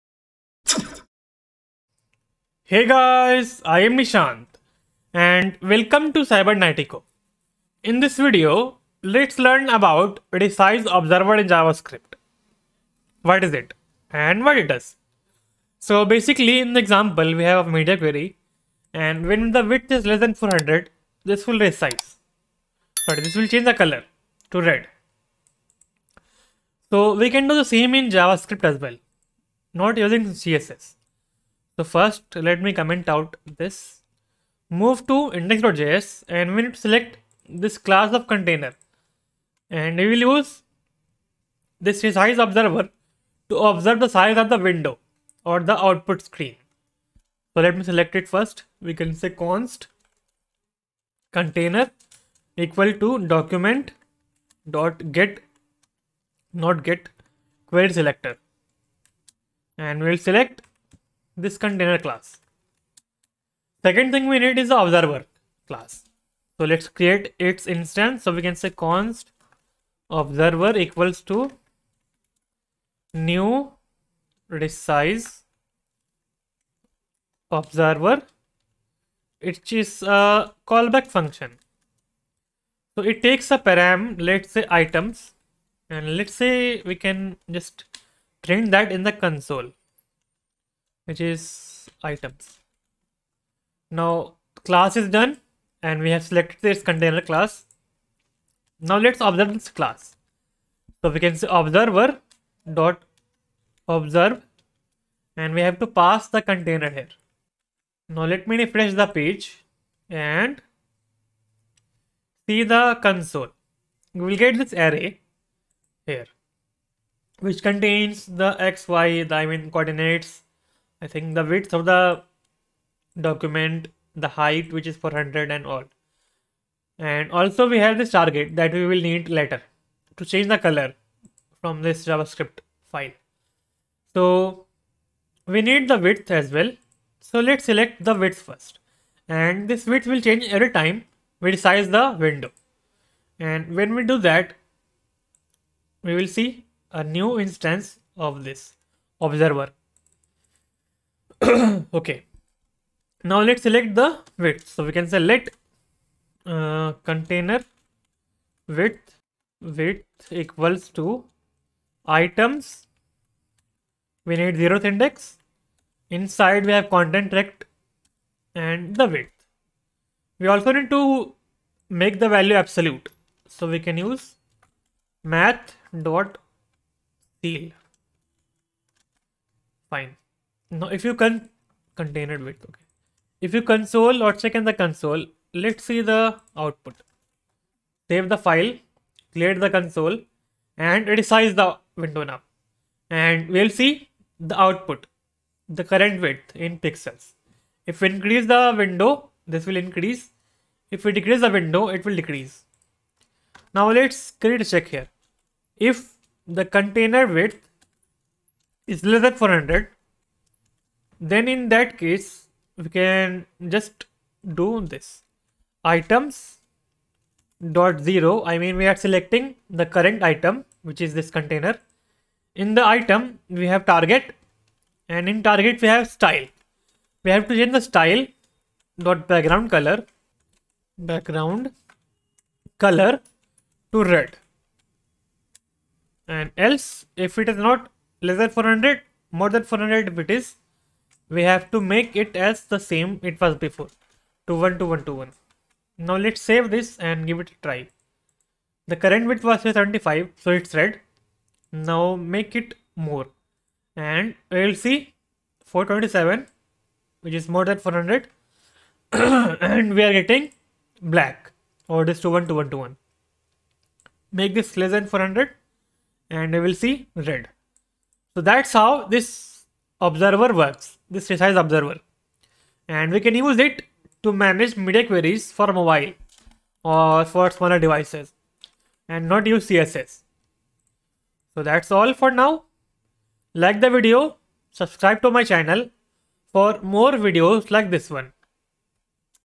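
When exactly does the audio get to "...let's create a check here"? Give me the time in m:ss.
3:23.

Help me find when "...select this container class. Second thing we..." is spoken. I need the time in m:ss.
1:00.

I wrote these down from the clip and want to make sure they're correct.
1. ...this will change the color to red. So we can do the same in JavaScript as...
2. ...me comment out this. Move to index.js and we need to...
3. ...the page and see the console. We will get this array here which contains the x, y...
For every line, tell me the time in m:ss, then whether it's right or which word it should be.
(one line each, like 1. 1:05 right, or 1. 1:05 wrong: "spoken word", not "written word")
1. 0:23 right
2. 0:32 right
3. 1:48 right.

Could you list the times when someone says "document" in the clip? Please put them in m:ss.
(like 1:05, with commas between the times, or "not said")
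0:53, 2:03.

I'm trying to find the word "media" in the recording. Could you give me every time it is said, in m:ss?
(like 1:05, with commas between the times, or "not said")
0:17, 4:34.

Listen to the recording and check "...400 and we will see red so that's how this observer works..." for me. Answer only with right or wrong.
right.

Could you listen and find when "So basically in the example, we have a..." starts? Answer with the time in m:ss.
0:15.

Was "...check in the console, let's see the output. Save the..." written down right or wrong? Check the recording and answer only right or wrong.
right.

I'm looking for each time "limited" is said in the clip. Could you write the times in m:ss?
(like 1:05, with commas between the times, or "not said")
not said.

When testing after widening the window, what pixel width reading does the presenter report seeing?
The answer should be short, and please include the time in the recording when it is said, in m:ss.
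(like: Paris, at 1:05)
427, at 4:15.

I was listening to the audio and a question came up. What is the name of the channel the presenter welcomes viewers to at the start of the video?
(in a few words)
Cybernatico.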